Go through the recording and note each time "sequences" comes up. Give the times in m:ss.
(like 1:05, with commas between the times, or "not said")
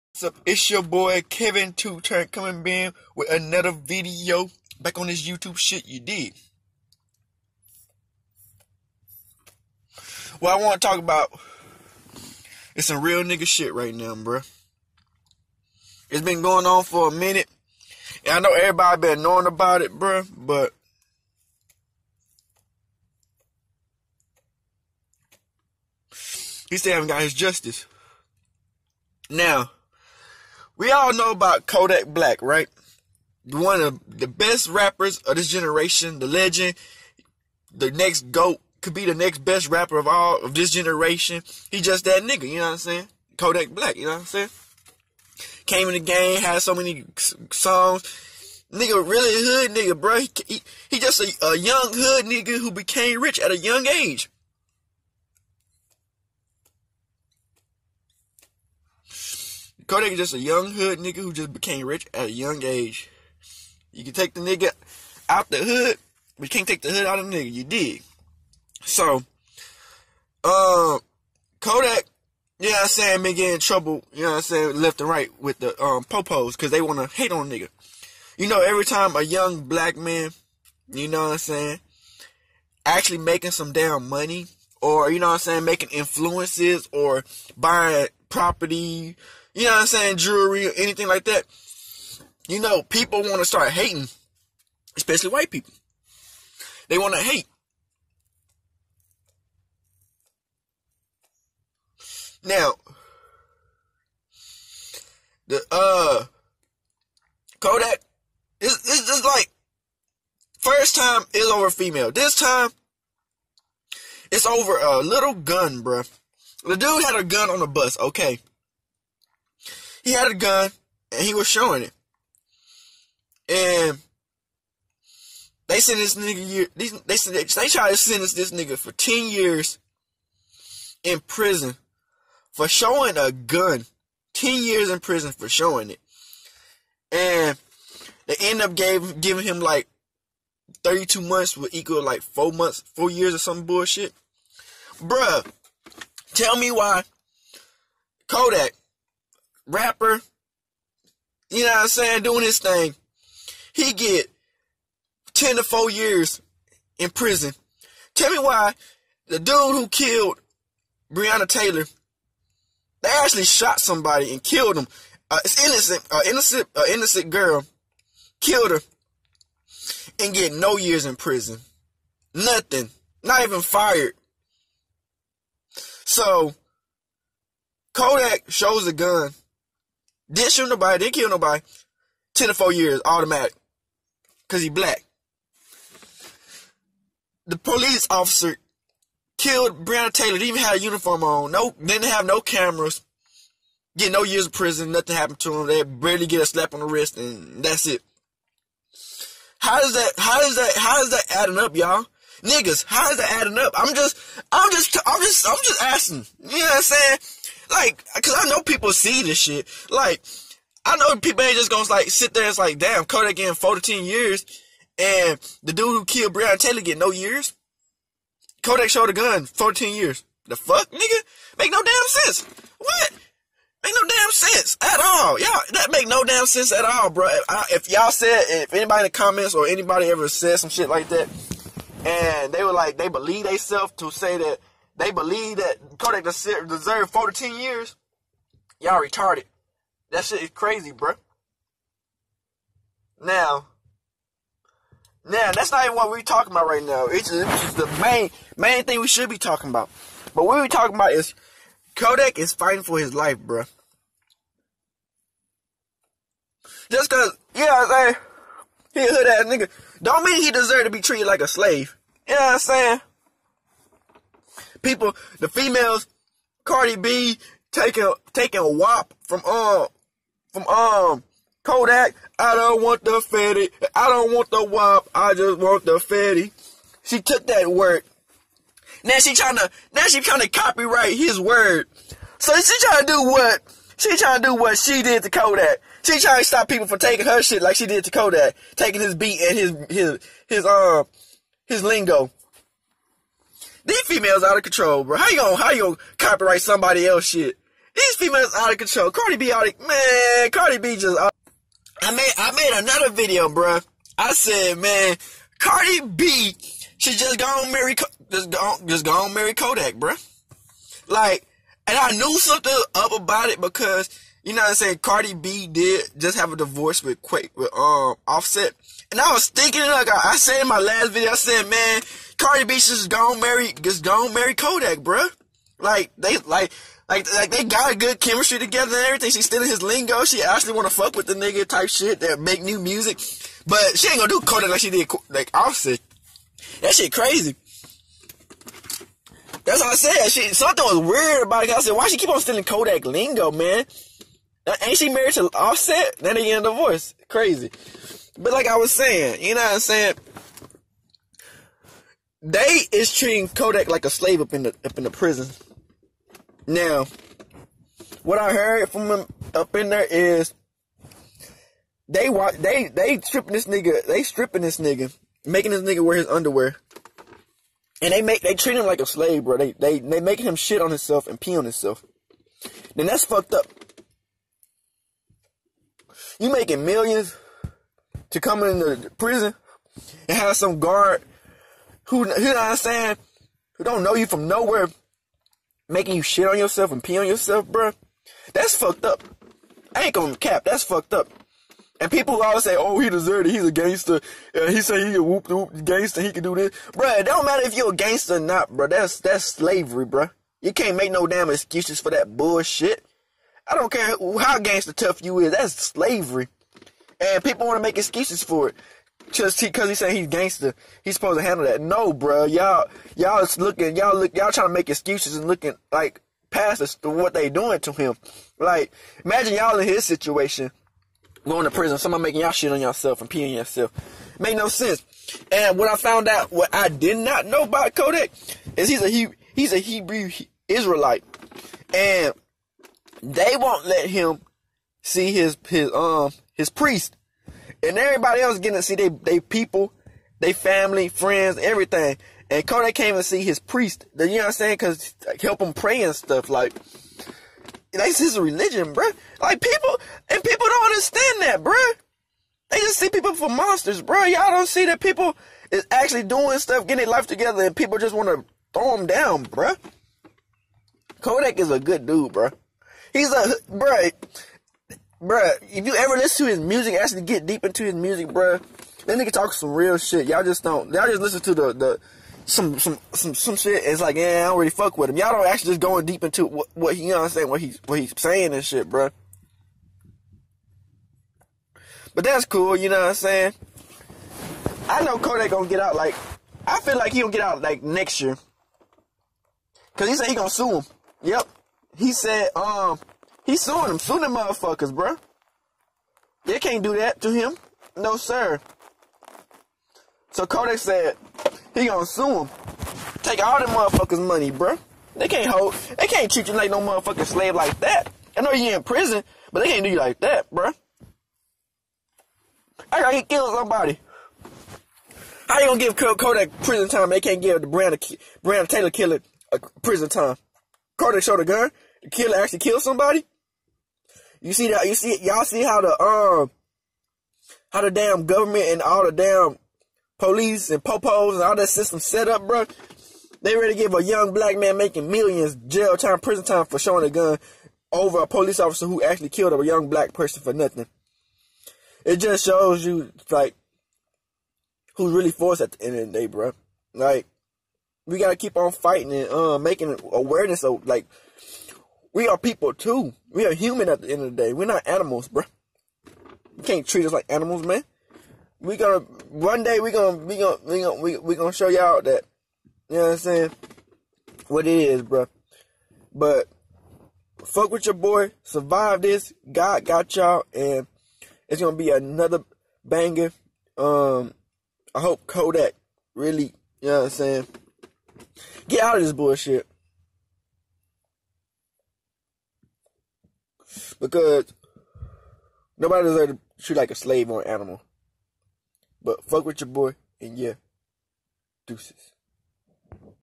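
not said.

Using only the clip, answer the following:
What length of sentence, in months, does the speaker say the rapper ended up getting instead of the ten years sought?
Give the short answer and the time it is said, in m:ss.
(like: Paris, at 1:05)
32 months, at 2:20.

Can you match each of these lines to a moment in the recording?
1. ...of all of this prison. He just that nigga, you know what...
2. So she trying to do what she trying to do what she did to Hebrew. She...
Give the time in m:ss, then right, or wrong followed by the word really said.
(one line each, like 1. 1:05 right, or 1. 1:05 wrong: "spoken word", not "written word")
1. 0:39 wrong: "generation", not "prison"
2. 4:42 wrong: "Kodak", not "Hebrew".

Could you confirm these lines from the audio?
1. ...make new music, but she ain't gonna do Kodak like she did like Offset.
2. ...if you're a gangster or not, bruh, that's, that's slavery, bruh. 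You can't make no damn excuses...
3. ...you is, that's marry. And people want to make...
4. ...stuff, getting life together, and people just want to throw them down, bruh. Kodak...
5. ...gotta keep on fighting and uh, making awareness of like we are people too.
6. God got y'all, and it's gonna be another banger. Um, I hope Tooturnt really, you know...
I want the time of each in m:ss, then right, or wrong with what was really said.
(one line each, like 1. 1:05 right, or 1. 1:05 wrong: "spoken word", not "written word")
1. 5:32 right
2. 6:37 right
3. 6:45 wrong: "slavery", not "marry"
4. 7:36 right
5. 9:08 right
6. 9:29 wrong: "Kodak", not "Tooturnt".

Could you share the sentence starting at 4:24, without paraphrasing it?
people, the females, Cardi B taking taking wop from um from um Kodak.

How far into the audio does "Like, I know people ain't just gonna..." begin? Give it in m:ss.
3:29.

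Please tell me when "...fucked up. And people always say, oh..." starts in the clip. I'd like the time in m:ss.
6:30.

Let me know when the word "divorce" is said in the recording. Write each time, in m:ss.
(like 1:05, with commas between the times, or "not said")
5:16, 5:46.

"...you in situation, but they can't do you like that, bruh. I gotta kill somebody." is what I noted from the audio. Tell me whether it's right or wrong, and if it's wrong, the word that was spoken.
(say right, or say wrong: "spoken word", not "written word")
wrong: "prison", not "situation".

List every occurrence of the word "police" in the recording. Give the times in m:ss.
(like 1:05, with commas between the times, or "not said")
3:07, 8:50, 8:58.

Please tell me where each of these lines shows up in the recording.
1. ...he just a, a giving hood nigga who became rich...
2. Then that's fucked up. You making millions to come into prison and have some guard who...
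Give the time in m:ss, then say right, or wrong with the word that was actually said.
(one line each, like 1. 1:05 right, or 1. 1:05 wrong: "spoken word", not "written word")
1. 0:50 wrong: "young", not "giving"
2. 6:12 right.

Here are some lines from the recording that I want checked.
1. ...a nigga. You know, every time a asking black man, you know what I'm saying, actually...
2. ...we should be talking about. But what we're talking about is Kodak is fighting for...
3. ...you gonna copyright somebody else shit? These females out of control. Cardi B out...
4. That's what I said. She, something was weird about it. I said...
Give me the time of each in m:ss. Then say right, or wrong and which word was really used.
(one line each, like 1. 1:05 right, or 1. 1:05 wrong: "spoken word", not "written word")
1. 1:17 wrong: "young", not "asking"
2. 4:08 right
3. 4:55 right
4. 5:39 right.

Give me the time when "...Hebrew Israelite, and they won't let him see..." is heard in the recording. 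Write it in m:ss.
7:09.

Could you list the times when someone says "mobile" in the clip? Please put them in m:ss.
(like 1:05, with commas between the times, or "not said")
not said.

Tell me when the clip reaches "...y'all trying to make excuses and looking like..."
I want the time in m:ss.
6:54.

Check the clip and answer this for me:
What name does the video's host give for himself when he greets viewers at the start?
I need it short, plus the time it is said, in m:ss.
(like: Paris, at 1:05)
Kevin Tooturnt, at 0:01.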